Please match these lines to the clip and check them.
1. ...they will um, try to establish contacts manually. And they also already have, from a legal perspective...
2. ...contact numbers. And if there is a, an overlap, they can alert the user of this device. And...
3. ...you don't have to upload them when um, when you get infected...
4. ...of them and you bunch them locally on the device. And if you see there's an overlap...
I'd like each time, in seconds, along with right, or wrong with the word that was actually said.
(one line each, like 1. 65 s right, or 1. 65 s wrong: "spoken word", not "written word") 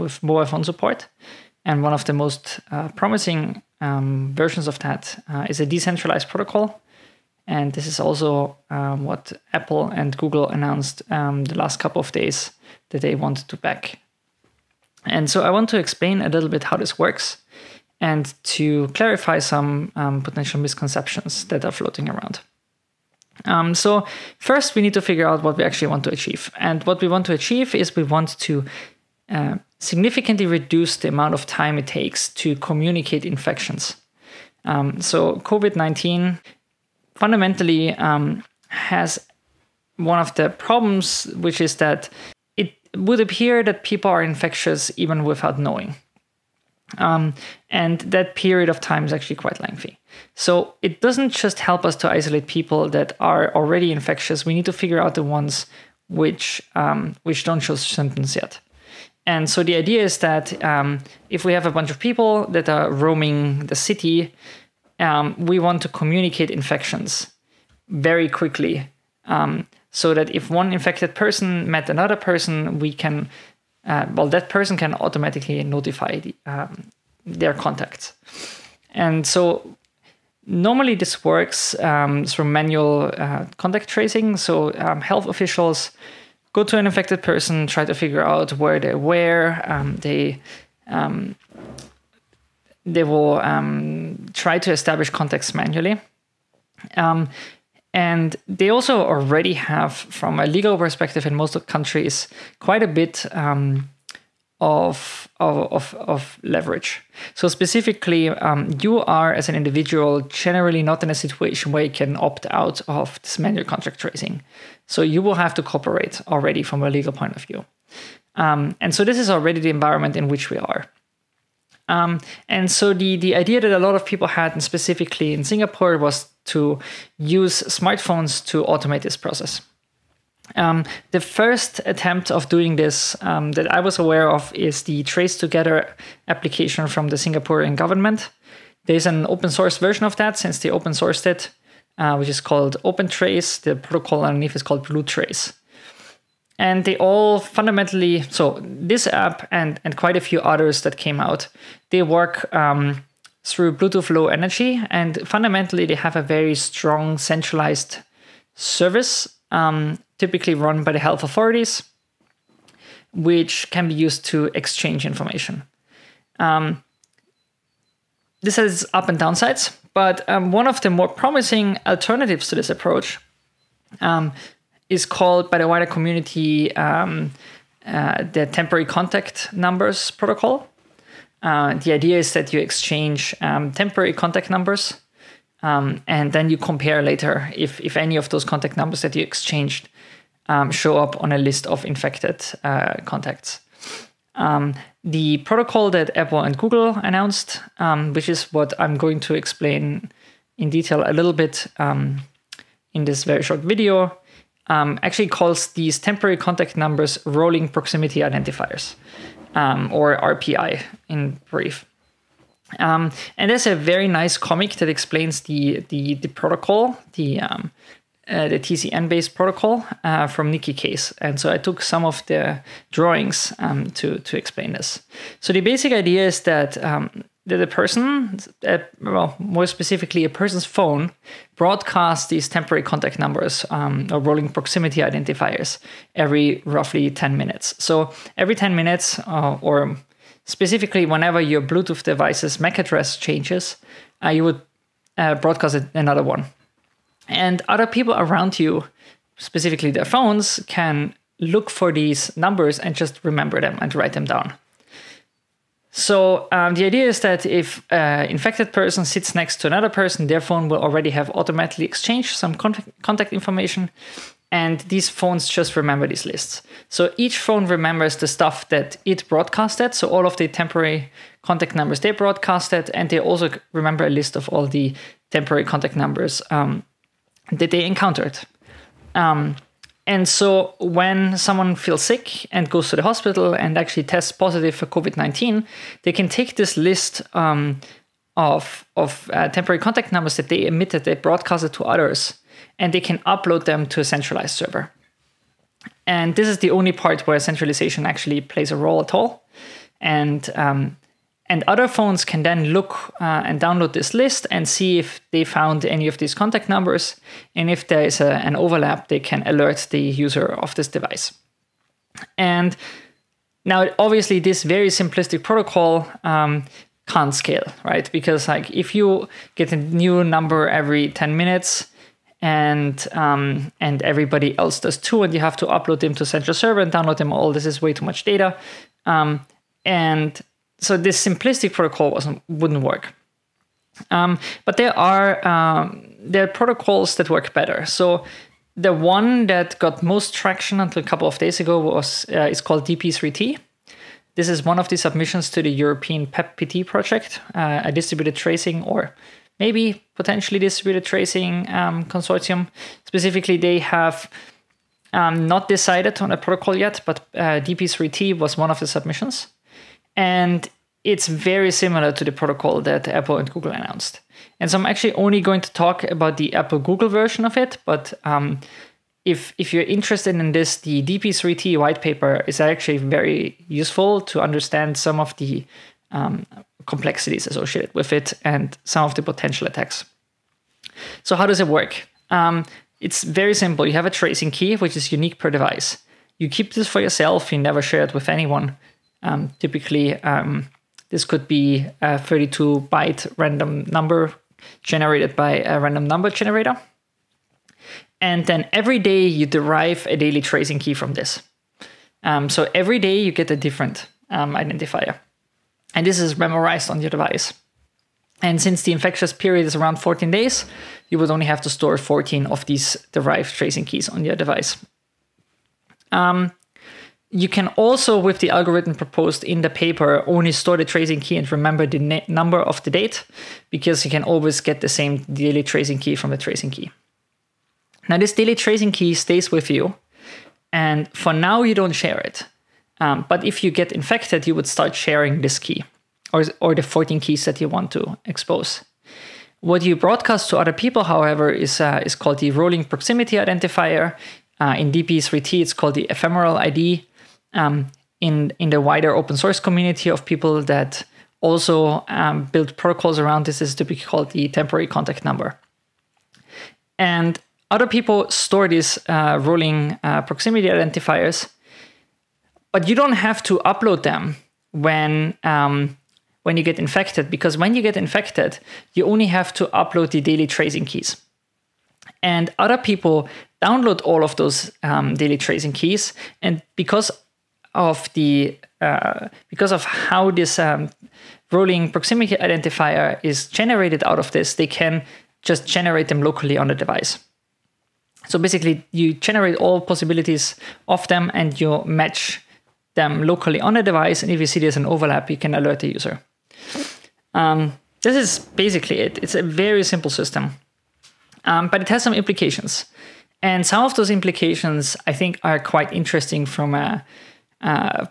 1. 92 s right
2. 306 s right
3. 462 s right
4. 490 s wrong: "match", not "bunch".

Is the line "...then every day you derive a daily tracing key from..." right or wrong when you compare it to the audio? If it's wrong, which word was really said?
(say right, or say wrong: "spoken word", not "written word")
right.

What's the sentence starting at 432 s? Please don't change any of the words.
Um, but if you get infected, you would start sharing this key or, or the 14 keys that you want to expose.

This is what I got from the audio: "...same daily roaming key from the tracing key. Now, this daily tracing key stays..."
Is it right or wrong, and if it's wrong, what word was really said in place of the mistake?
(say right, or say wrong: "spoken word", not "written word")
wrong: "tracing", not "roaming".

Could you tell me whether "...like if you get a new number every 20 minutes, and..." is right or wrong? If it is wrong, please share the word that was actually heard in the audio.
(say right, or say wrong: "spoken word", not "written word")
wrong: "10", not "20".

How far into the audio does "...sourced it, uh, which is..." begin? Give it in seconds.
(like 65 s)
140 s.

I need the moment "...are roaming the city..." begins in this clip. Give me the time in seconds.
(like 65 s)
62 s.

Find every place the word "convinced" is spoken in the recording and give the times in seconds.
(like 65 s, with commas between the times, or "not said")
not said.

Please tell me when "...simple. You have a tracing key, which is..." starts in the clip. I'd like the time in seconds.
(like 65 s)
383 s.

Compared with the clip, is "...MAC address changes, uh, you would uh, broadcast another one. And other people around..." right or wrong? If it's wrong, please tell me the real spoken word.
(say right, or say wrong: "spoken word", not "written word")
right.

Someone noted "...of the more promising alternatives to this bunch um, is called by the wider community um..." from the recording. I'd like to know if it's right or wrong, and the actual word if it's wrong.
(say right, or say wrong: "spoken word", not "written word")
wrong: "approach", not "bunch".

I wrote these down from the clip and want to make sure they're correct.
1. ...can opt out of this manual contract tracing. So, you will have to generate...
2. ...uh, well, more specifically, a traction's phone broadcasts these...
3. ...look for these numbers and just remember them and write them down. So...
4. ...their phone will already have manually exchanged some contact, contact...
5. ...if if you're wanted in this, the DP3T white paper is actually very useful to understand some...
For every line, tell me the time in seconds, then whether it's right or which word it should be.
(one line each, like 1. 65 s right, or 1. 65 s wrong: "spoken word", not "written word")
1. 111 s wrong: "cooperate", not "generate"
2. 228 s wrong: "person", not "traction"
3. 251 s right
4. 260 s wrong: "automatically", not "manually"
5. 369 s wrong: "interested", not "wanted".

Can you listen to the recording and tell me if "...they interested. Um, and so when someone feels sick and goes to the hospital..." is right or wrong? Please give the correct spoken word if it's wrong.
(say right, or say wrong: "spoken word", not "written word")
wrong: "encountered", not "interested".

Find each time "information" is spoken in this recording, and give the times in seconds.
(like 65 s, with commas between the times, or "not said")
165 s, 263 s.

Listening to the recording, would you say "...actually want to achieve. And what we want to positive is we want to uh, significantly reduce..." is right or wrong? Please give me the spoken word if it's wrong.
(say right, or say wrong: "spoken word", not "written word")
wrong: "achieve", not "positive".